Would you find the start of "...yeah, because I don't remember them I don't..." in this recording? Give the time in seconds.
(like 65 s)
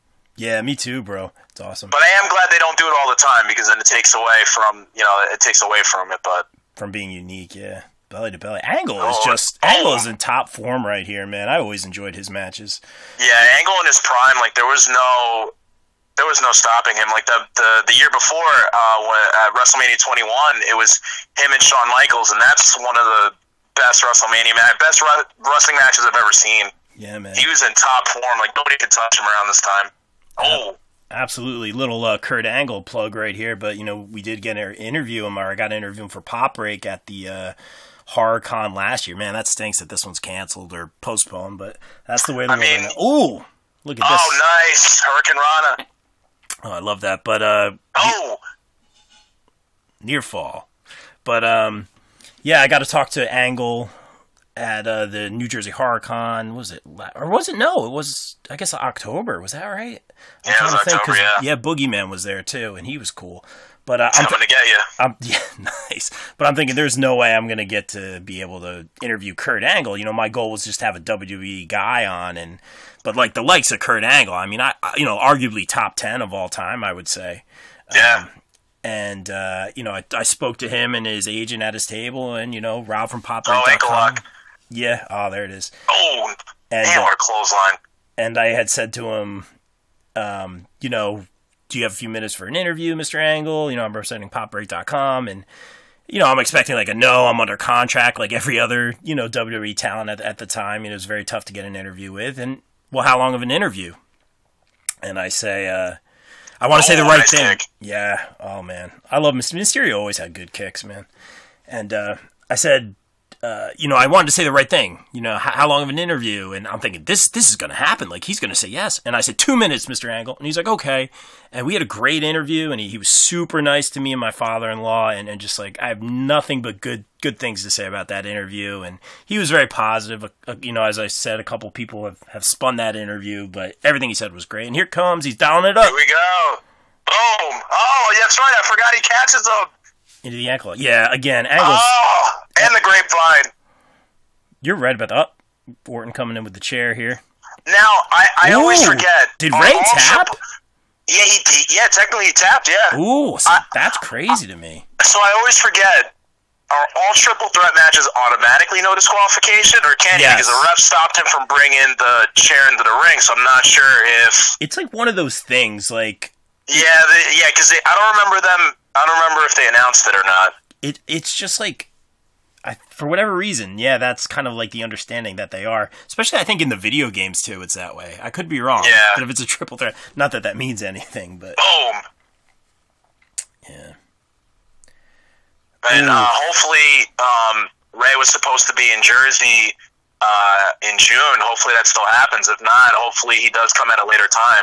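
167 s.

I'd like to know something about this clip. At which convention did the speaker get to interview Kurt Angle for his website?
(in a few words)
New Jersey Horror Con.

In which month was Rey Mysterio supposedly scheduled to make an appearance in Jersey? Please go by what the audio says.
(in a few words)
June.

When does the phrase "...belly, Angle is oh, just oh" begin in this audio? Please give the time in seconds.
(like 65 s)
8 s.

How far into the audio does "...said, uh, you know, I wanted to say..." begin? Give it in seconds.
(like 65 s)
112 s.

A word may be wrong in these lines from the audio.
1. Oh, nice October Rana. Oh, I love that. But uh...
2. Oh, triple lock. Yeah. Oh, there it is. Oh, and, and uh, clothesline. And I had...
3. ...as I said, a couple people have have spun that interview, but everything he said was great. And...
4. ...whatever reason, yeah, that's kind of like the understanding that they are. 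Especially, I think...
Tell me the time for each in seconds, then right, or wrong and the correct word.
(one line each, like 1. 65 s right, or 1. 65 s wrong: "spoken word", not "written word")
1. 44 s wrong: "Hurricane", not "October"
2. 83 s wrong: "ankle", not "triple"
3. 130 s right
4. 173 s right.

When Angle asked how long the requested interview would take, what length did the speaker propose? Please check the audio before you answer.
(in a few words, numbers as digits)
2 minutes.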